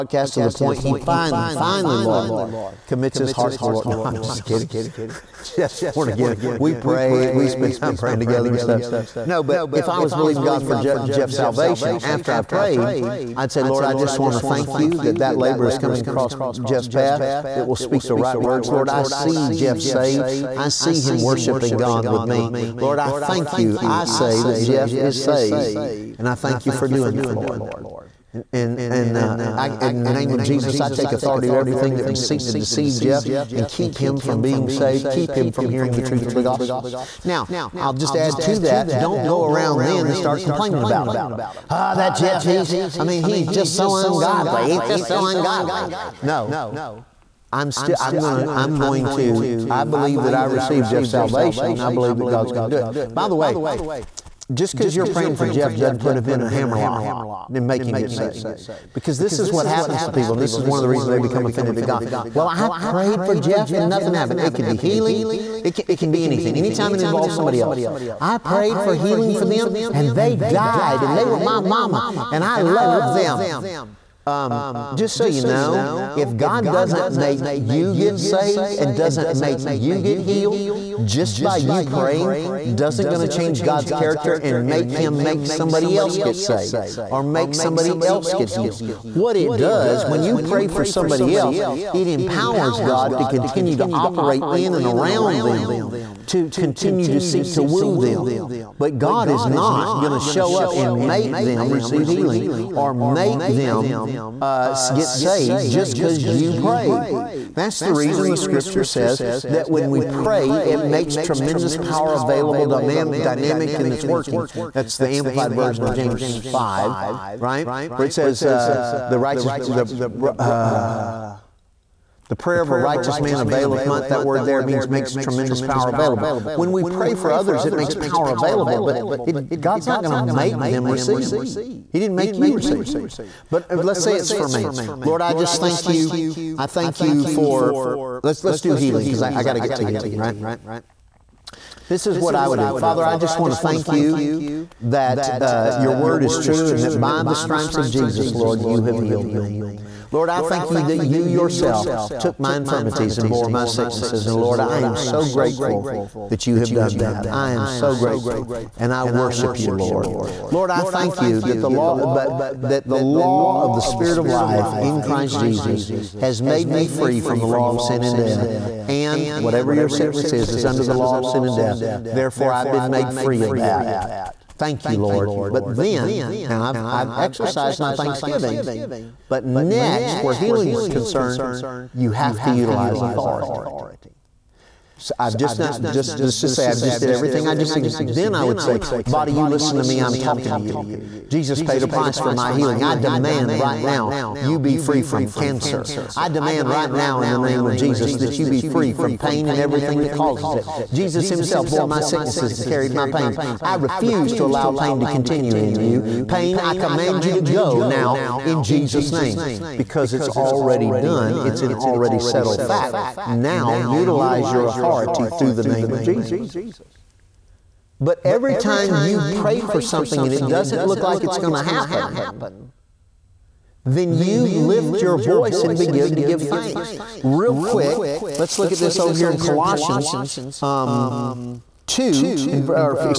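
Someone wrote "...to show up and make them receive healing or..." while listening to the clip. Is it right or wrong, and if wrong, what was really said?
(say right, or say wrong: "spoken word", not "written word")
right.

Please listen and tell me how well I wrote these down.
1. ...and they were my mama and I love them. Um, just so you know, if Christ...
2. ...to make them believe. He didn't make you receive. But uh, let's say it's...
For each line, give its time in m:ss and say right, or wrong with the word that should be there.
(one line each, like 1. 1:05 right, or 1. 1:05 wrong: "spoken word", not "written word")
1. 1:11 wrong: "God", not "Christ"
2. 2:10 wrong: "receive", not "believe".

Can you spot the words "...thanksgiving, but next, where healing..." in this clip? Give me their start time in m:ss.
2:57.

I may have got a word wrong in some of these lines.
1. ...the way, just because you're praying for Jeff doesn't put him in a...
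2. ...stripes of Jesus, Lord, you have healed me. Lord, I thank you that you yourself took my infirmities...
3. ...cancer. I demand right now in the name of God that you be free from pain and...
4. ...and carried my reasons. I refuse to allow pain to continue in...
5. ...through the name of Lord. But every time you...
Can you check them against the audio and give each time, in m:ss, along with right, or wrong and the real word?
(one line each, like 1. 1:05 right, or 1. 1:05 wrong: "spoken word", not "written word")
1. 0:53 right
2. 2:27 right
3. 3:15 wrong: "Jesus", not "God"
4. 3:22 wrong: "pains", not "reasons"
5. 3:35 wrong: "Jesus", not "Lord".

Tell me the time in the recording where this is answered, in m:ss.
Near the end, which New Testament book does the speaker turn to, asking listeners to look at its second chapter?
3:49.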